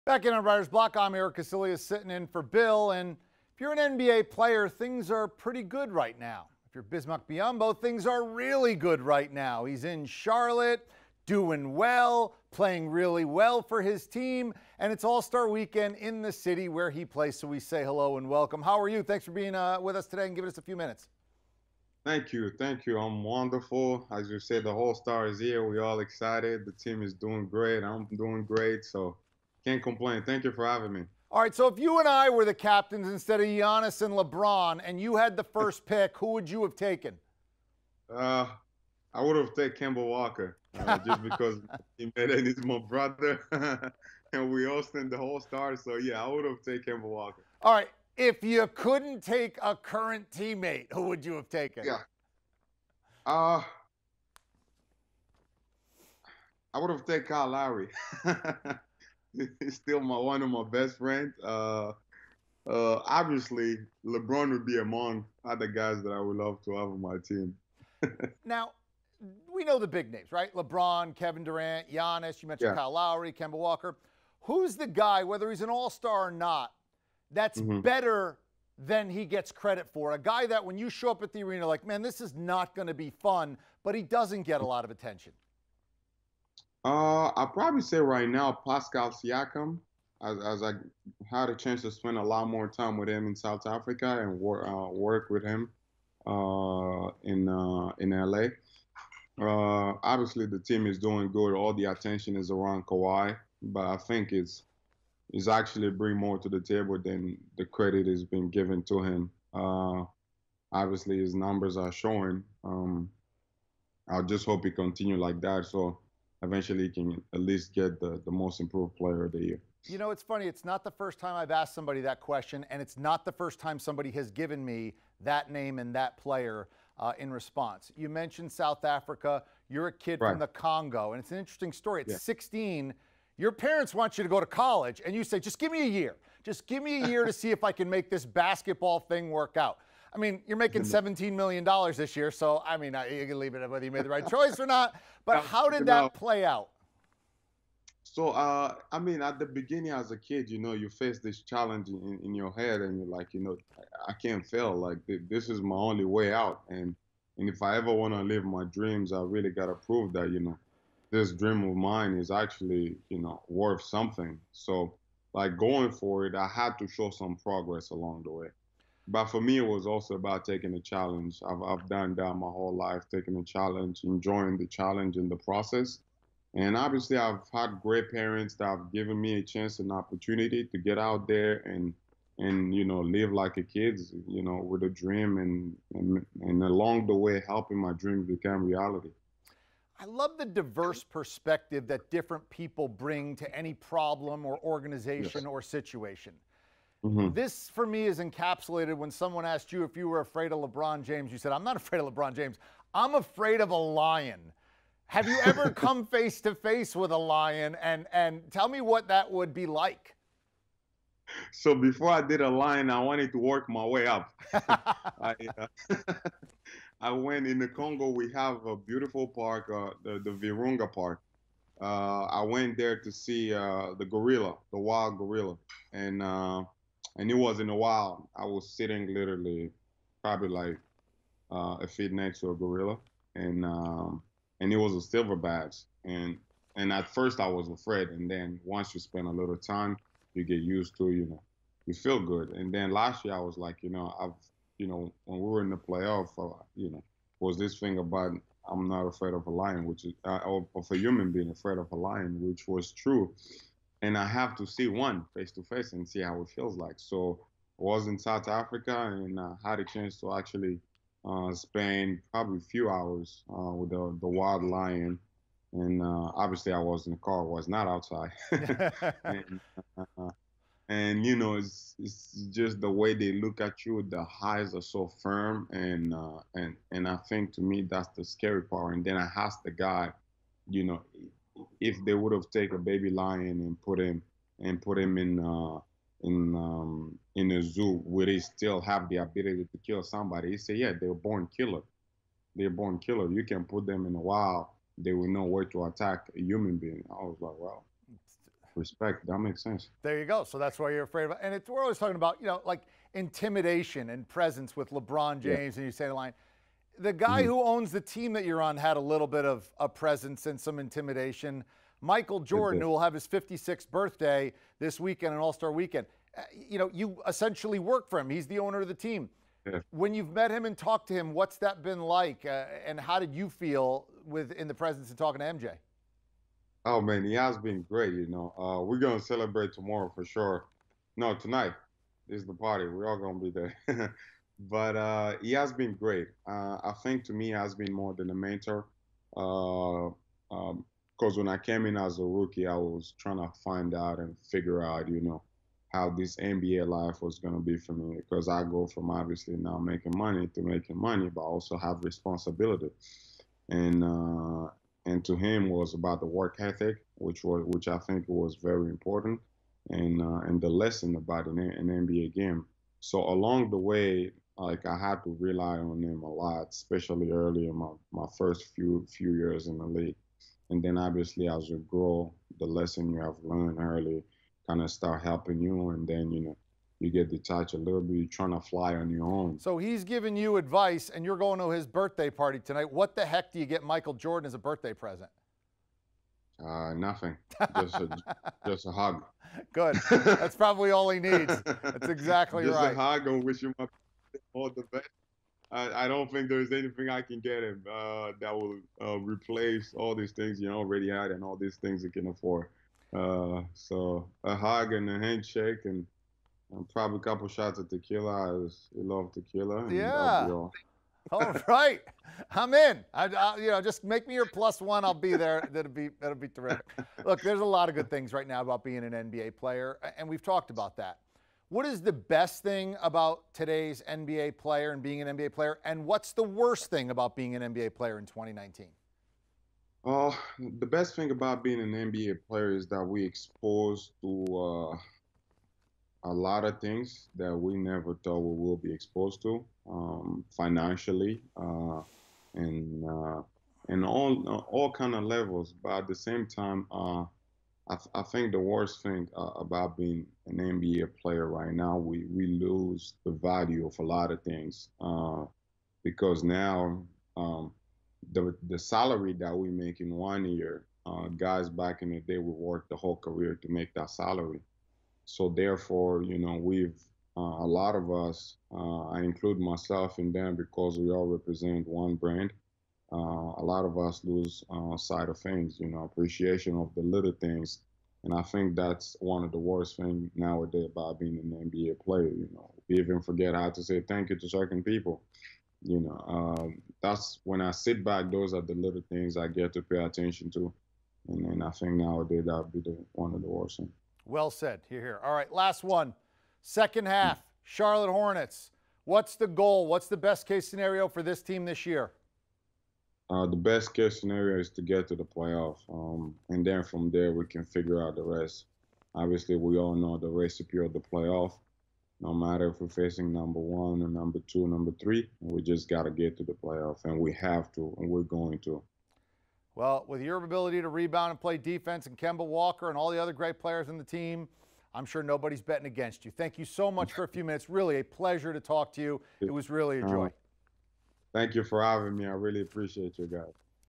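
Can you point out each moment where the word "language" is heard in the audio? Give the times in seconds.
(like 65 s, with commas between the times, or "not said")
not said.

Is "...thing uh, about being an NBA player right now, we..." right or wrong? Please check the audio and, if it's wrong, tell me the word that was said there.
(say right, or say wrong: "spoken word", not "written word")
right.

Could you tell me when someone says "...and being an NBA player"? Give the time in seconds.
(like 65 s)
424 s.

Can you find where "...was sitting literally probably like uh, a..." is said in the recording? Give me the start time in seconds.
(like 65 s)
228 s.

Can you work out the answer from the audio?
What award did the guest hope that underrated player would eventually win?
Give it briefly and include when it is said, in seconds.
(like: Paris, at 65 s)
Most improved player, at 118 s.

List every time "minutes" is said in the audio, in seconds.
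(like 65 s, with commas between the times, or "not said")
20 s, 527 s.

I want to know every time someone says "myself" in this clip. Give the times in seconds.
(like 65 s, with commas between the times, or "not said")
469 s.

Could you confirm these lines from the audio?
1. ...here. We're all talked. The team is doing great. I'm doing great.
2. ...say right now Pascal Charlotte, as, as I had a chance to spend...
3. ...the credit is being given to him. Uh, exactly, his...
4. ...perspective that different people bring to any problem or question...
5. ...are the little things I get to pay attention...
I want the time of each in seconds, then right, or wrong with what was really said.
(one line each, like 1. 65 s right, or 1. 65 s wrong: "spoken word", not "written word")
1. 25 s wrong: "excited", not "talked"
2. 87 s wrong: "Siakam", not "Charlotte"
3. 107 s wrong: "obviously", not "exactly"
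4. 191 s wrong: "organization", not "question"
5. 488 s right.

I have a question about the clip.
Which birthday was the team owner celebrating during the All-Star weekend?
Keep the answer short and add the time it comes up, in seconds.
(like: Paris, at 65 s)
56th, at 313 s.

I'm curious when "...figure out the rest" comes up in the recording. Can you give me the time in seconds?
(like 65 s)
507 s.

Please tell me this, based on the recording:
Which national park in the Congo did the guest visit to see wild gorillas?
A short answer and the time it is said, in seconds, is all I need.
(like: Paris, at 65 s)
Virunga Park, at 220 s.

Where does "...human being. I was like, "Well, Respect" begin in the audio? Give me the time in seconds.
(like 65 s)
296 s.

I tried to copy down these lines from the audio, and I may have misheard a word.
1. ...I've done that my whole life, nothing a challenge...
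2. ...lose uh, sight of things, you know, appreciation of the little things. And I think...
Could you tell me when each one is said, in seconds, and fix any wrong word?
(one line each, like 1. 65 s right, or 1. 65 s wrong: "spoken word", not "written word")
1. 171 s wrong: "taking", not "nothing"
2. 474 s right.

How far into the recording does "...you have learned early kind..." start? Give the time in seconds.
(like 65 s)
373 s.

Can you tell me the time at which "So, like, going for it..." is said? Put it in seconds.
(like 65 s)
164 s.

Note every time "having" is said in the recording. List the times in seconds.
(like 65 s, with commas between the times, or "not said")
30 s, 531 s.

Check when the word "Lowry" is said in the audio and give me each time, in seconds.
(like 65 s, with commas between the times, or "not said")
57 s, 72 s.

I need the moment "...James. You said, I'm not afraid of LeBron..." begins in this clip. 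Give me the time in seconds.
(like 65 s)
201 s.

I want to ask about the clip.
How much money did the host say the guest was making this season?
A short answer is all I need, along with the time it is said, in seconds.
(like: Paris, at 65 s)
$17 million, at 140 s.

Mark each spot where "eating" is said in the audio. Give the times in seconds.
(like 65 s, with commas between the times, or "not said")
not said.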